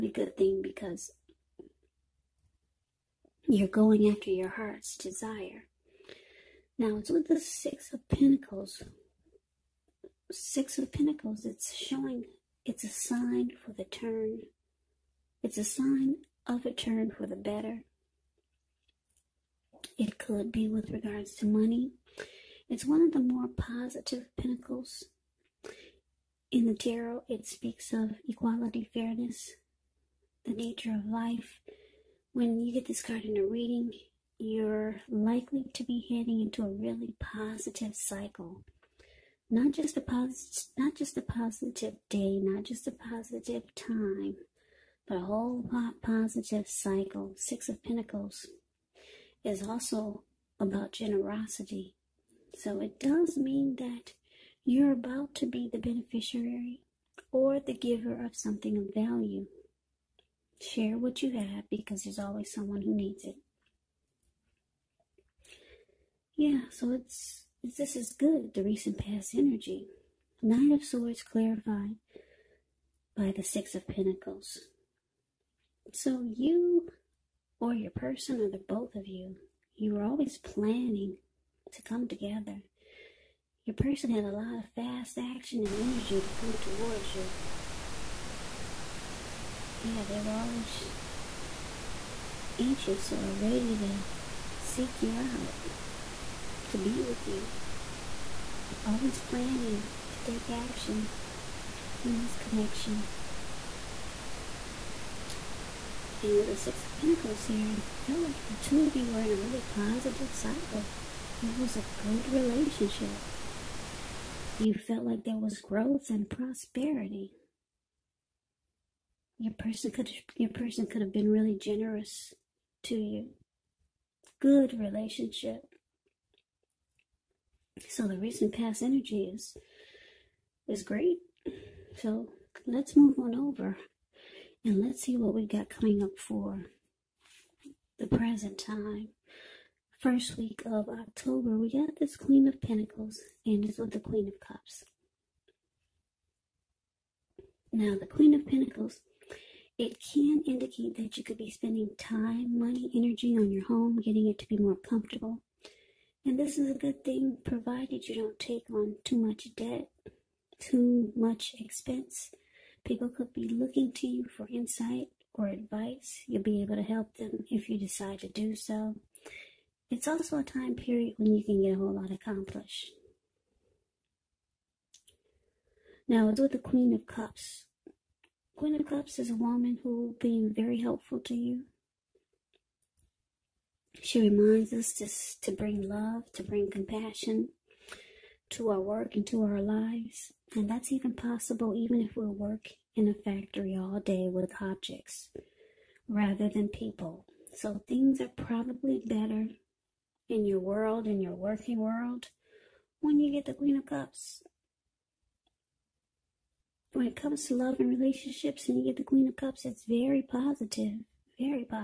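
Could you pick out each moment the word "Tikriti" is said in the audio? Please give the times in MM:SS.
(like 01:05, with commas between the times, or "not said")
not said.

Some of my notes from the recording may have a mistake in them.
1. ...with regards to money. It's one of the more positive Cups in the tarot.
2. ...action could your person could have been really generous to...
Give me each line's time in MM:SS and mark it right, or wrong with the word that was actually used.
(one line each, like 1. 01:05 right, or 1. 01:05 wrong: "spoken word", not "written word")
1. 00:20 wrong: "Pentacles", not "Cups"
2. 01:59 wrong: "person", not "action".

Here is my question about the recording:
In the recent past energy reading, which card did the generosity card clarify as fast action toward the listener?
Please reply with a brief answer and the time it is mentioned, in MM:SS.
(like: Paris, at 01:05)
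Knight of Swords, at 01:10.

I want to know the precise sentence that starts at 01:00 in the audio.
Share what you have because there's always someone who needs it.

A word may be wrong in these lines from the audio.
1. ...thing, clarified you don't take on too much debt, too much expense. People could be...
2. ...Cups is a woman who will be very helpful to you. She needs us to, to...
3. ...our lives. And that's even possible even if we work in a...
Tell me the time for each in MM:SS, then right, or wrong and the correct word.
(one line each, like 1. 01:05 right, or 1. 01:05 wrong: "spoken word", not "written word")
1. 02:37 wrong: "provided", not "clarified"
2. 02:58 wrong: "reminds", not "needs"
3. 03:09 right.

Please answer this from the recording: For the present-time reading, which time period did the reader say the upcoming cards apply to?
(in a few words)
first week of October.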